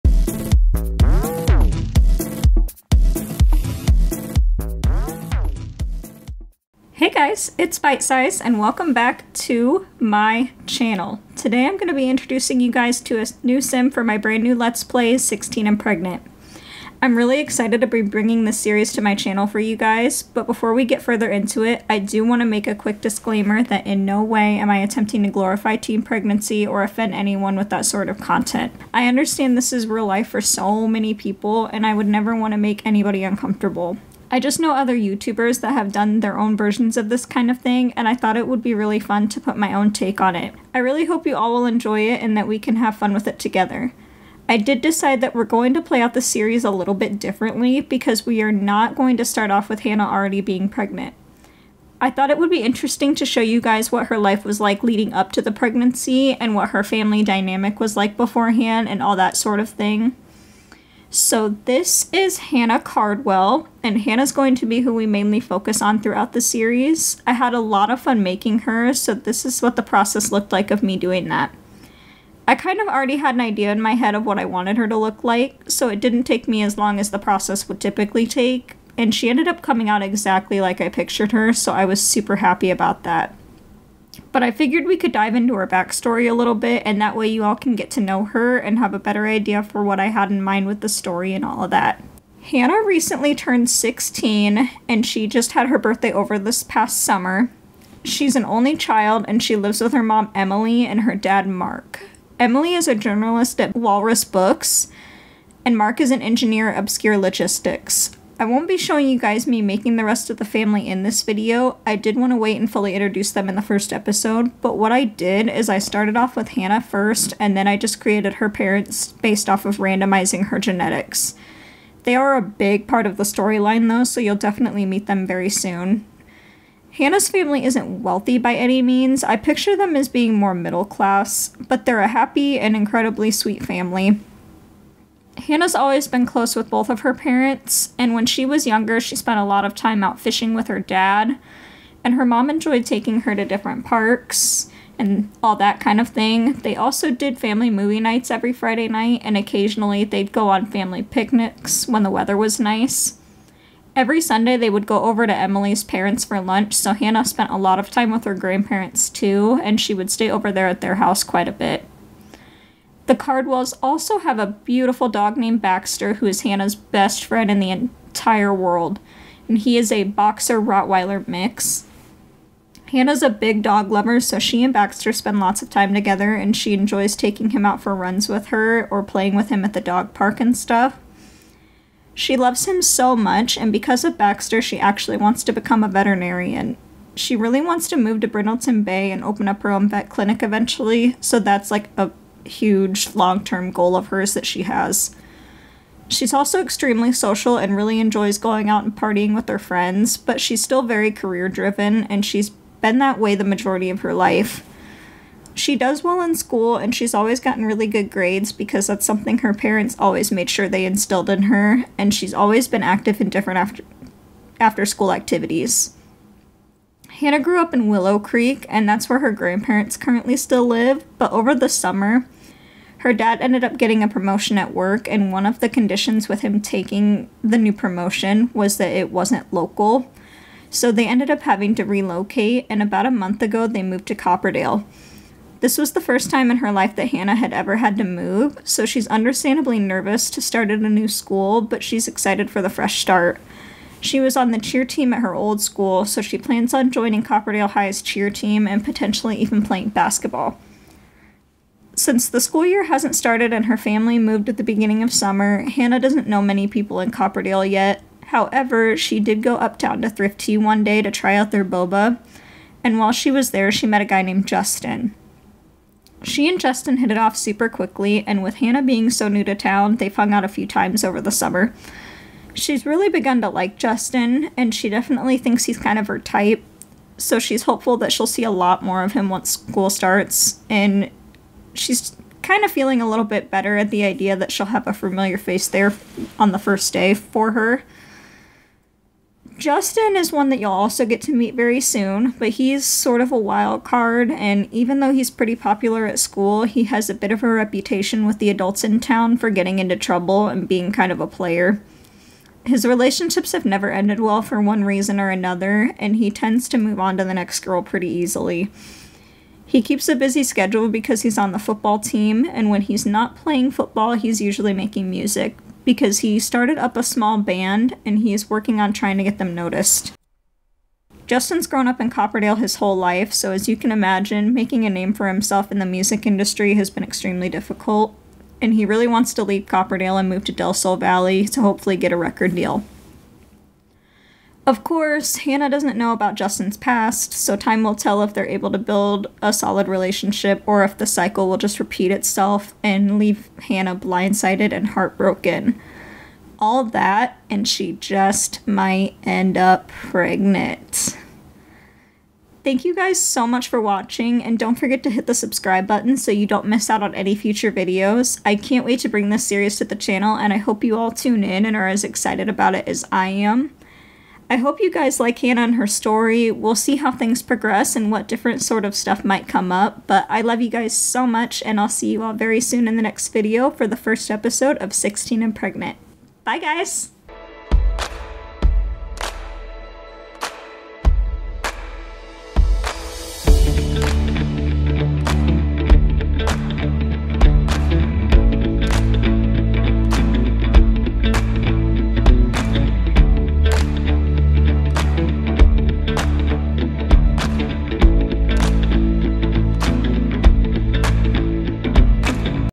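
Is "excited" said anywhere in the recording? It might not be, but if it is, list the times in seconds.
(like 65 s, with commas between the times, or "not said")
17 s, 242 s, 362 s.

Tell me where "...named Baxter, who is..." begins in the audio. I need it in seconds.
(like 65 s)
165 s.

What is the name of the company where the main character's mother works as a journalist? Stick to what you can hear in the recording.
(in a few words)
Walrus Books.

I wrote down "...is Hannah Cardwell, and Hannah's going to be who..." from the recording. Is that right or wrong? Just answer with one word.
right.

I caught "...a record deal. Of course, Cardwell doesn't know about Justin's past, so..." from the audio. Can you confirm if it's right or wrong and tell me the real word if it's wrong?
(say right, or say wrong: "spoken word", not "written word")
wrong: "Hannah", not "Cardwell".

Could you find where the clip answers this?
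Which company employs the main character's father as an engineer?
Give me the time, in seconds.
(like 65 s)
106 s.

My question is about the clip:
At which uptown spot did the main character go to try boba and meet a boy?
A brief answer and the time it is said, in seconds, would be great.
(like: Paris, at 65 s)
Thrifty, at 260 s.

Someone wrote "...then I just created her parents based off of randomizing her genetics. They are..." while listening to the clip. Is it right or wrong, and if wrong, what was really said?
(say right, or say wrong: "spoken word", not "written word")
right.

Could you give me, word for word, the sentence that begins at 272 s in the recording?
She's really begun to like Justin, and she definitely thinks he's kind of her type.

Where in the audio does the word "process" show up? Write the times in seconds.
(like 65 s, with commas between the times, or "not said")
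69 s, 77 s.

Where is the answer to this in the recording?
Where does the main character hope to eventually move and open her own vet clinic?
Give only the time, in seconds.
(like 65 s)
188 s.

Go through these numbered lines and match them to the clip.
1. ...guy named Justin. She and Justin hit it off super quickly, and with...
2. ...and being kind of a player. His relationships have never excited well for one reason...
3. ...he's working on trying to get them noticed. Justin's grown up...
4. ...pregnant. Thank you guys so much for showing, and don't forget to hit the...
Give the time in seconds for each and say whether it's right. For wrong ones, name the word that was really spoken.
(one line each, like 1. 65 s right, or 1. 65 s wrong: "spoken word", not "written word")
1. 264 s right
2. 300 s wrong: "ended", not "excited"
3. 318 s right
4. 349 s wrong: "watching", not "showing".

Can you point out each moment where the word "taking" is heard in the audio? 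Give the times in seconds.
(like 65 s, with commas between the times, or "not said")
142 s, 177 s, 226 s.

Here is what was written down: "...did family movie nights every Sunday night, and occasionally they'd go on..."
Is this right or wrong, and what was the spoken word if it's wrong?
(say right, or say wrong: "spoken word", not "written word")
wrong: "Friday", not "Sunday".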